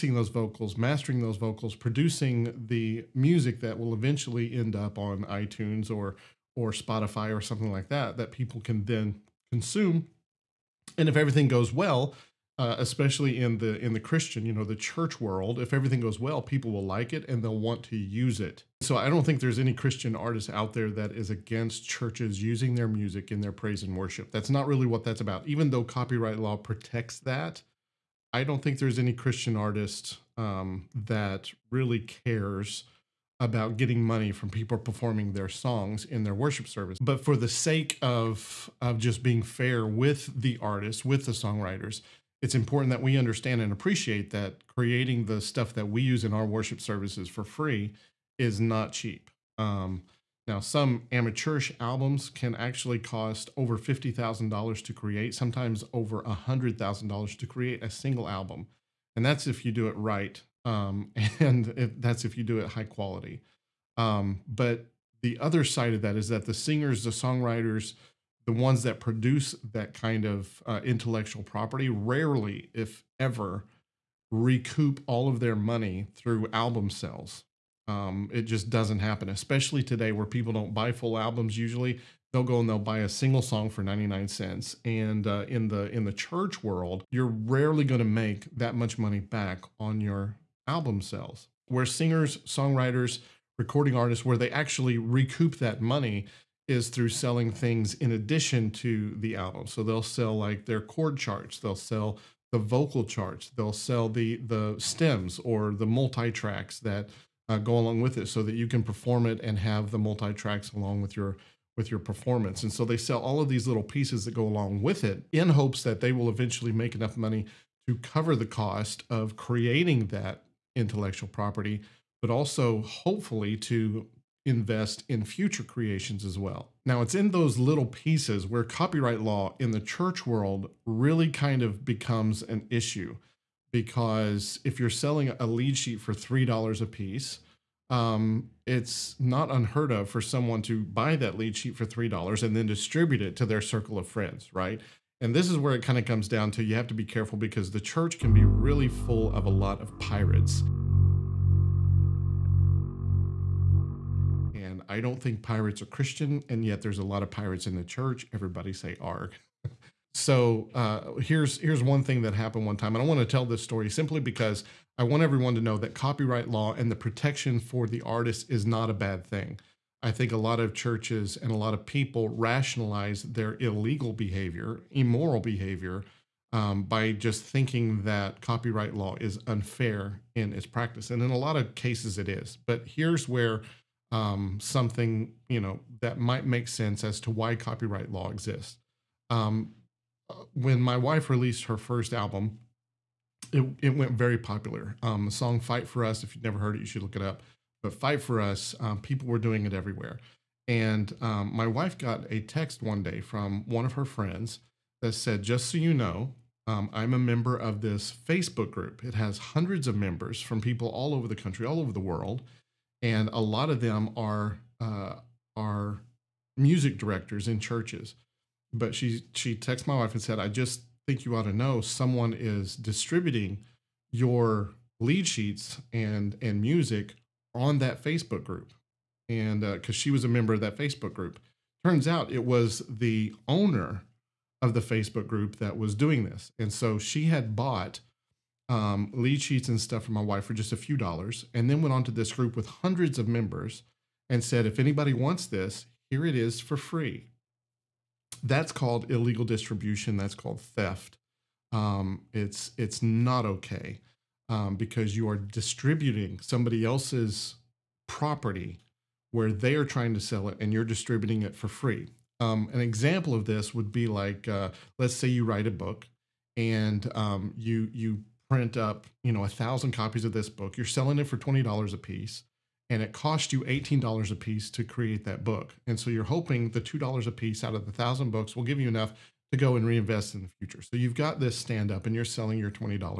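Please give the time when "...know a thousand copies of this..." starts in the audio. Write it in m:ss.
4:29.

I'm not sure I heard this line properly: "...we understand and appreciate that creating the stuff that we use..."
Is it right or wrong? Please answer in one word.
right.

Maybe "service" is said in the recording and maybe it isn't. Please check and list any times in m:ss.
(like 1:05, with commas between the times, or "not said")
0:36, 0:46.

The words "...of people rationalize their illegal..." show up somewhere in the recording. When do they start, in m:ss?
2:51.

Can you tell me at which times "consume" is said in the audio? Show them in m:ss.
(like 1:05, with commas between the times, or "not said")
0:09.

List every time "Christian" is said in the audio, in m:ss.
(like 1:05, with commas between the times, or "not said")
0:14, 0:19, 0:29, 2:35.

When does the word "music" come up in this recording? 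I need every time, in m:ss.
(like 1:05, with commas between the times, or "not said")
0:03, 0:22, 3:36, 3:46.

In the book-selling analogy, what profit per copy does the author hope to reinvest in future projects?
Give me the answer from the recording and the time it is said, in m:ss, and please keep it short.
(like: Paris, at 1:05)
$2, at 4:36.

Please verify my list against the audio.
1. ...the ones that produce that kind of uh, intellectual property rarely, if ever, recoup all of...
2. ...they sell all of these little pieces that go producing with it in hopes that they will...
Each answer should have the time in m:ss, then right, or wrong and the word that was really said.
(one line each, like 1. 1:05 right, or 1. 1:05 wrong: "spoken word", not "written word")
1. 1:08 right
2. 1:52 wrong: "along", not "producing".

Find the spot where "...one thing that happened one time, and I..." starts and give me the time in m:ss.
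2:41.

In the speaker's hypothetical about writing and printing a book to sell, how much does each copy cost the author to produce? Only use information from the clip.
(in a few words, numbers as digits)
$18.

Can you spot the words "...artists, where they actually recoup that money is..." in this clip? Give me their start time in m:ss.
1:33.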